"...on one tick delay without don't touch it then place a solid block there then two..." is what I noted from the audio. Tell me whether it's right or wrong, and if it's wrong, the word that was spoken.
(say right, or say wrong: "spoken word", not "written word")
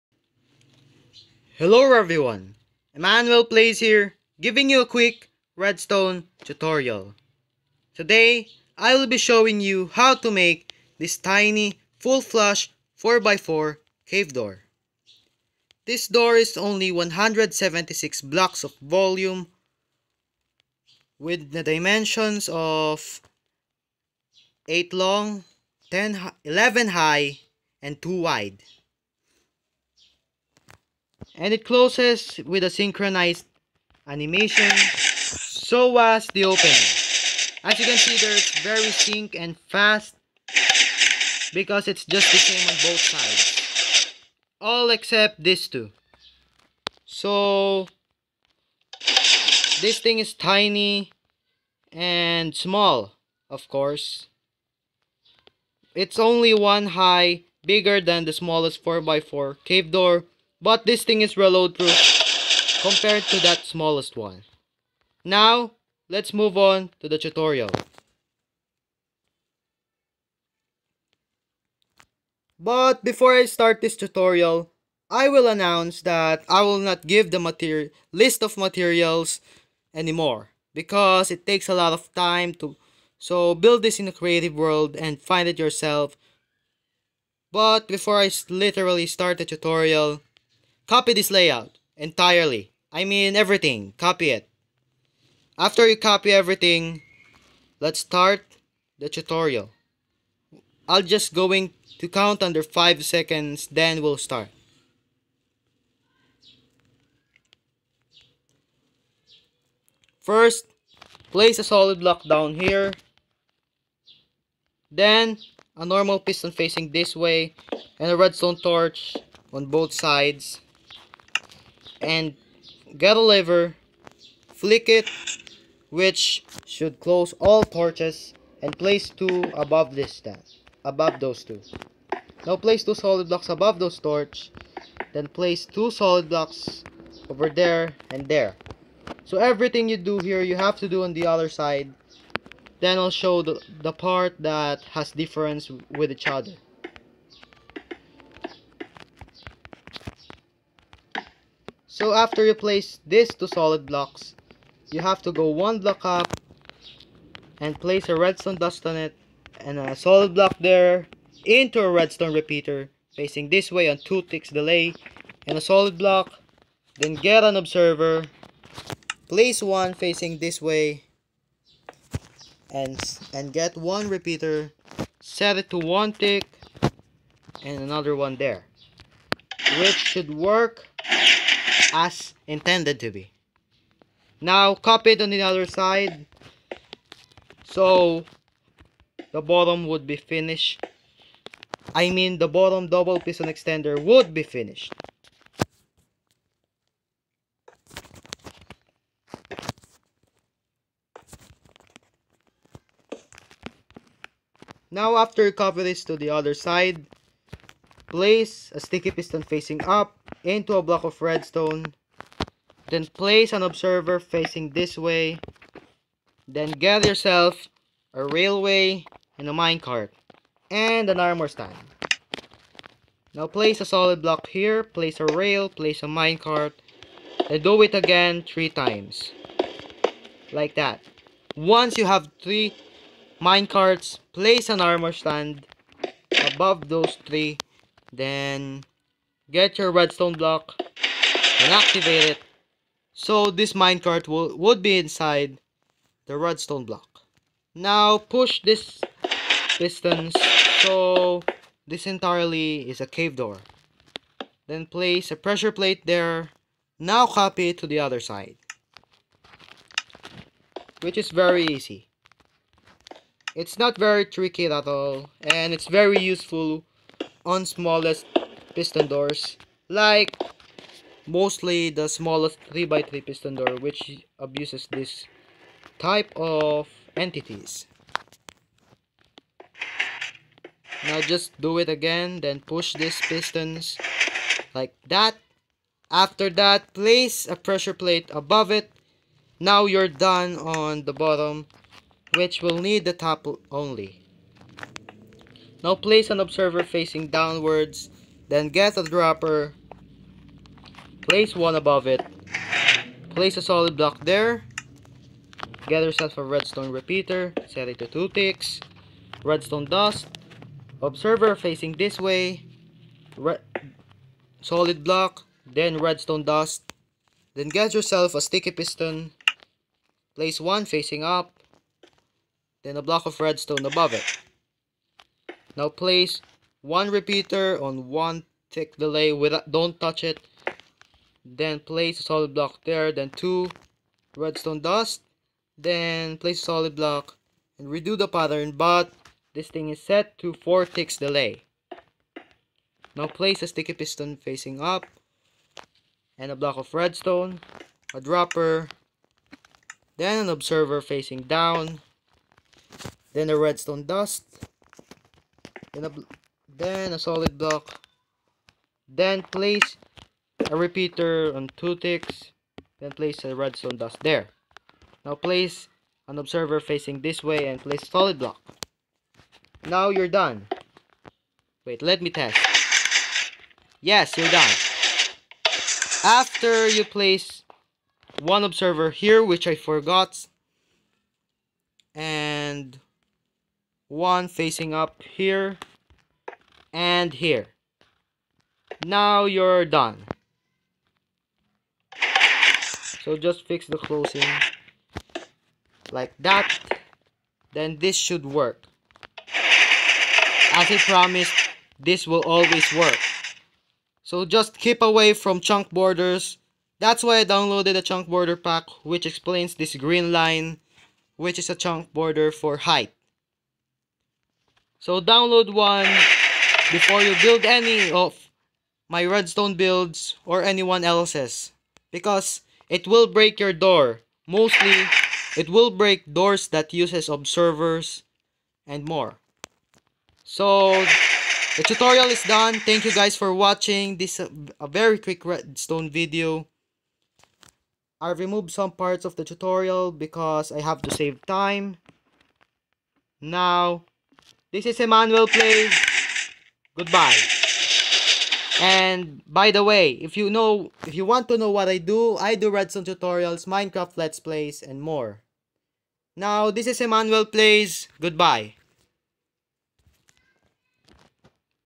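right.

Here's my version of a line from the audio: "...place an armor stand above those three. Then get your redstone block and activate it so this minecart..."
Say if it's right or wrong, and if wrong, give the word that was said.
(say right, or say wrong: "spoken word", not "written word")
right.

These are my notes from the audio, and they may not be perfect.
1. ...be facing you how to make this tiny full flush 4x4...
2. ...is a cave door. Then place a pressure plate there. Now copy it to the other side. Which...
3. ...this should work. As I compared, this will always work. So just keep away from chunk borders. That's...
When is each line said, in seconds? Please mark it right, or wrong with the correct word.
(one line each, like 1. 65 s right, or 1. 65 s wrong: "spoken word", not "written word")
1. 9 s wrong: "showing", not "facing"
2. 252 s right
3. 397 s wrong: "promised", not "compared".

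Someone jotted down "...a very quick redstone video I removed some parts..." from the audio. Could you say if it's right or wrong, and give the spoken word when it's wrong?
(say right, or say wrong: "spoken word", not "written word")
right.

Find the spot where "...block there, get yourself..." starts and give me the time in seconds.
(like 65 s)
303 s.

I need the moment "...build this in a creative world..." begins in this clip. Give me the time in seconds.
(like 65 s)
83 s.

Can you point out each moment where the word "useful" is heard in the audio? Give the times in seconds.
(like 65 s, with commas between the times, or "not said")
266 s.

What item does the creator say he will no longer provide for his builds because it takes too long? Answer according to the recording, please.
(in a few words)
material list.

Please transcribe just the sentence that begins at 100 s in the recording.
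I'll just going to count under 5 seconds then we'll start.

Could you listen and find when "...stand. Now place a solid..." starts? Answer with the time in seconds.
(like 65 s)
221 s.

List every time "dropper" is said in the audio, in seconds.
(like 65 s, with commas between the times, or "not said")
299 s, 348 s.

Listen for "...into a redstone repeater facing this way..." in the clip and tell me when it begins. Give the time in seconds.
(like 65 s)
161 s.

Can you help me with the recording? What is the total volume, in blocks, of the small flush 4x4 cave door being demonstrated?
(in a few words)
176.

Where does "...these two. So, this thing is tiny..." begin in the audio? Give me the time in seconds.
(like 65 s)
45 s.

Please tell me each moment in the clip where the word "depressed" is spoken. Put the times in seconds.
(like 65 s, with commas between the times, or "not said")
not said.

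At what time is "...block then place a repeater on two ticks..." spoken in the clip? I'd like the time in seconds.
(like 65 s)
357 s.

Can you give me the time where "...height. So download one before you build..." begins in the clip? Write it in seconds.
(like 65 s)
412 s.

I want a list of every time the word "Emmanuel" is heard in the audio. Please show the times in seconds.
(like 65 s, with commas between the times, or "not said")
2 s, 444 s, 456 s.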